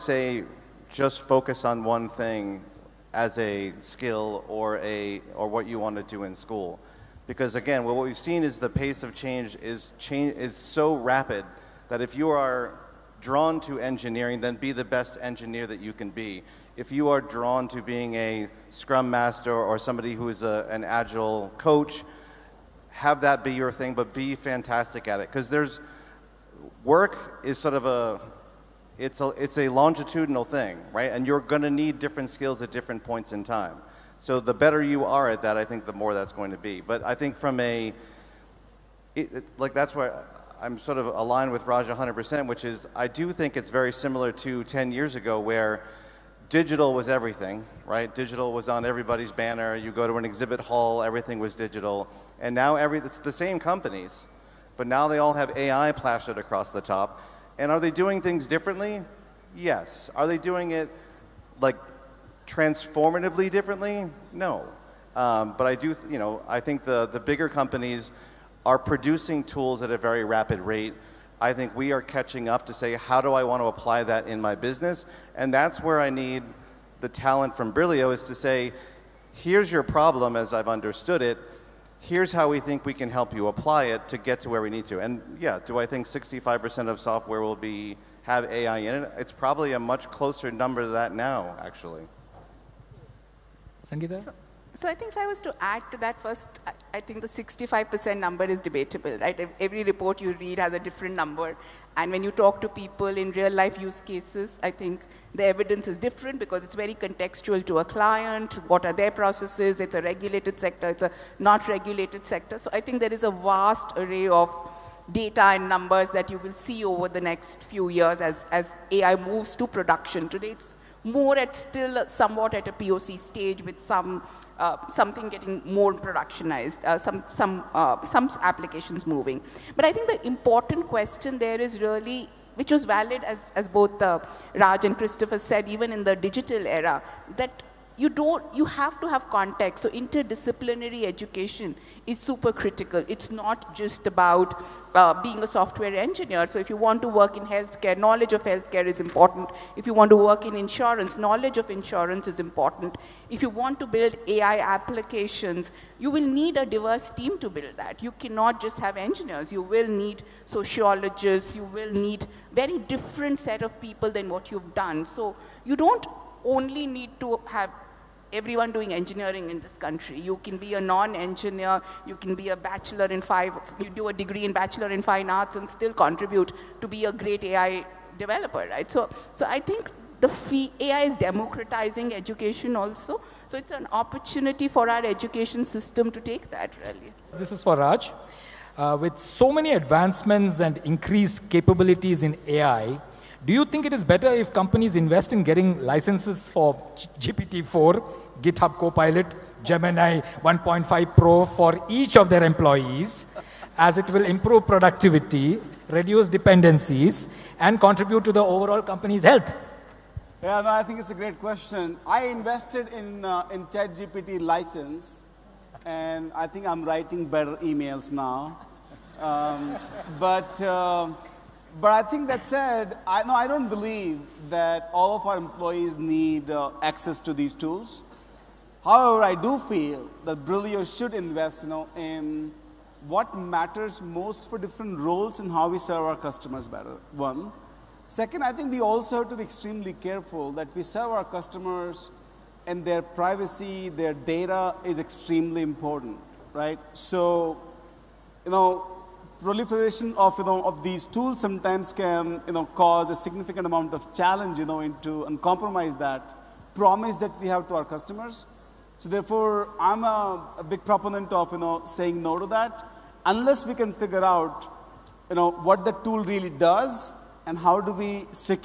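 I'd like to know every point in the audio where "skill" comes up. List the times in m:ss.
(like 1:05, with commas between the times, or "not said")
0:03, 0:32.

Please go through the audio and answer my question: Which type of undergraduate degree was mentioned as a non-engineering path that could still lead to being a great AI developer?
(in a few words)
Bachelor in fine arts.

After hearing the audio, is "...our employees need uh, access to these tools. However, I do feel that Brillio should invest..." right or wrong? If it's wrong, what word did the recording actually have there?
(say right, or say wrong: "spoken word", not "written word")
right.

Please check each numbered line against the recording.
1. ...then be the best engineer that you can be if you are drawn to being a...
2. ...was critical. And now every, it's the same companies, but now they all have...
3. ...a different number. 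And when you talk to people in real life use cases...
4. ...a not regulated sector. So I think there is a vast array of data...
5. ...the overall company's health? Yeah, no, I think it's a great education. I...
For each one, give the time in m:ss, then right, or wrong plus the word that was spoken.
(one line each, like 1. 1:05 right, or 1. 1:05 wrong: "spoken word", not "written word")
1. 0:14 right
2. 0:51 wrong: "digital", not "critical"
3. 1:40 right
4. 1:51 right
5. 3:28 wrong: "question", not "education".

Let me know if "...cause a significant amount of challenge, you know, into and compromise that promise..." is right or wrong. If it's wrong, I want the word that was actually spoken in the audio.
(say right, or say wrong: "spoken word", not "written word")
right.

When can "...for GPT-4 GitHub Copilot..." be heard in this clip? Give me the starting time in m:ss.
3:16.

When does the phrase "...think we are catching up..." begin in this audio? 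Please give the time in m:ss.
1:11.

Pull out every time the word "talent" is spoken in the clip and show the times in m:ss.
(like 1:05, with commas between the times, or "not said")
1:17.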